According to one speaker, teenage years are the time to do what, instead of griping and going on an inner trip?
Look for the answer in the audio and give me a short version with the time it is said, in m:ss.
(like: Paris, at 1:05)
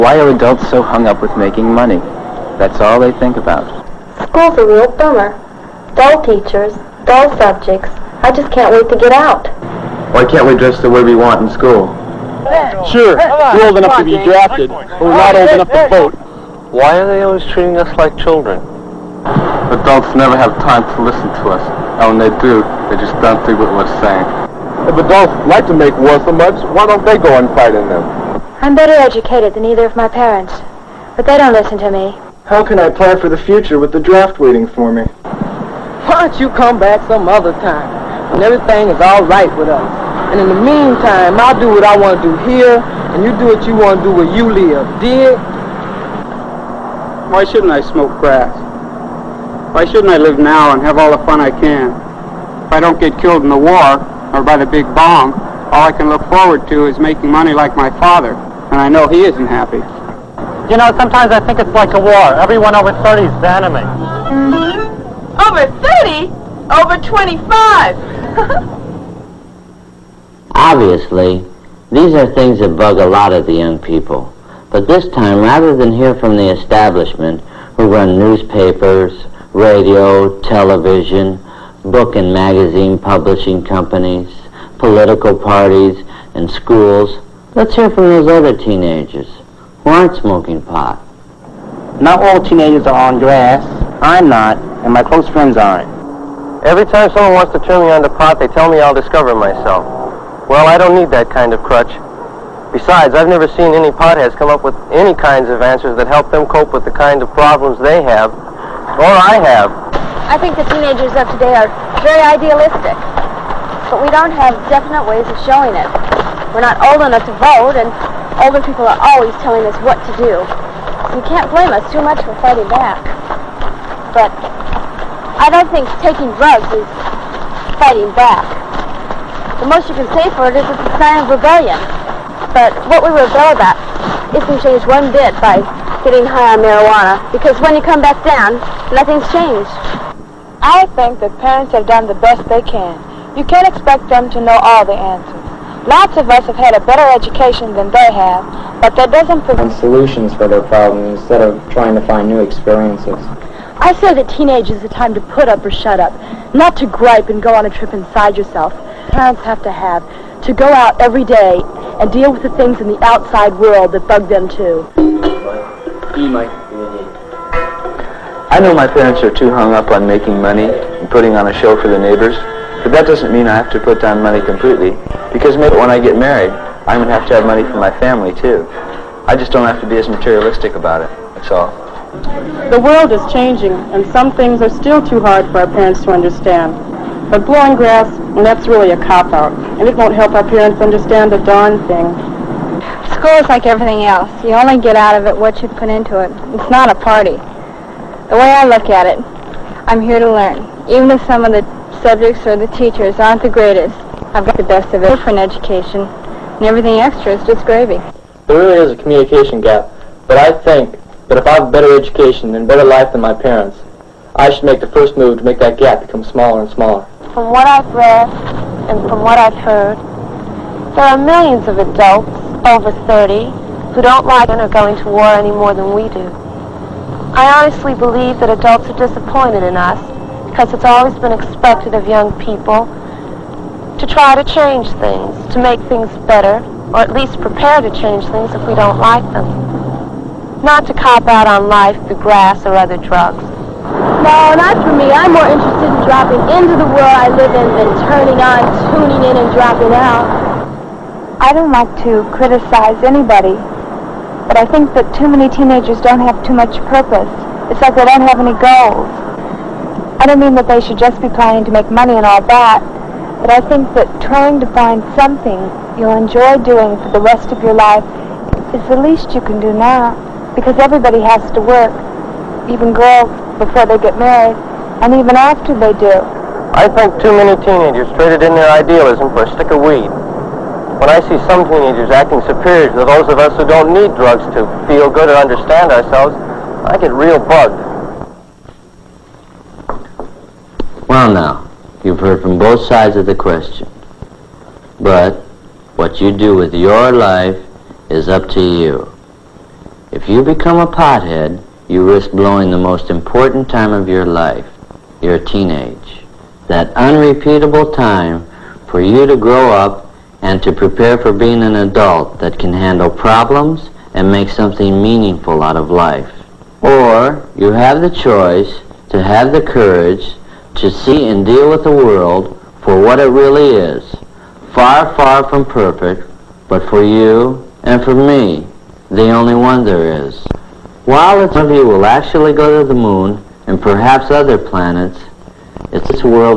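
put up or shut up, at 2:35.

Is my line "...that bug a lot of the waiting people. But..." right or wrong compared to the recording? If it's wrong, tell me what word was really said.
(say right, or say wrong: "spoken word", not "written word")
wrong: "young", not "waiting".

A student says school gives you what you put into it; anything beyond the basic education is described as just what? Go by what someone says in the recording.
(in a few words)
gravy.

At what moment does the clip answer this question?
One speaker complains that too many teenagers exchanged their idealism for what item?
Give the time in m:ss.
4:39.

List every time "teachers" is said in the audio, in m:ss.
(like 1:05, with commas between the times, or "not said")
0:06, 3:22.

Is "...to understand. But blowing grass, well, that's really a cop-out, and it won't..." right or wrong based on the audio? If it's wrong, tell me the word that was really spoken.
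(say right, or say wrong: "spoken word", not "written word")
right.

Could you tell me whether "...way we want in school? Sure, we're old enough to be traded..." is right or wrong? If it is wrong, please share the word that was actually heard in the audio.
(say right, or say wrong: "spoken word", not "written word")
wrong: "drafted", not "traded".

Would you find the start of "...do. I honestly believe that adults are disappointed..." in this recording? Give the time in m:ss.
3:46.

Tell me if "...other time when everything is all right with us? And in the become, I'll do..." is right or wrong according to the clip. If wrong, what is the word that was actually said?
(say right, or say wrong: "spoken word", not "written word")
wrong: "meantime", not "become".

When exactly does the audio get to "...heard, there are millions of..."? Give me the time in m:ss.
3:39.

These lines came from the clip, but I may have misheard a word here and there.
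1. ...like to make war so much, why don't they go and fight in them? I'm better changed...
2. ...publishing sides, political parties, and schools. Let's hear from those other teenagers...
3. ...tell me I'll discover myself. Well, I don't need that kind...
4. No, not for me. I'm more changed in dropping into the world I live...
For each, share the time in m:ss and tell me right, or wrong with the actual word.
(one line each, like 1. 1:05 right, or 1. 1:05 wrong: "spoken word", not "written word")
1. 0:25 wrong: "educated", not "changed"
2. 1:22 wrong: "companies", not "sides"
3. 1:38 right
4. 4:04 wrong: "interested", not "changed".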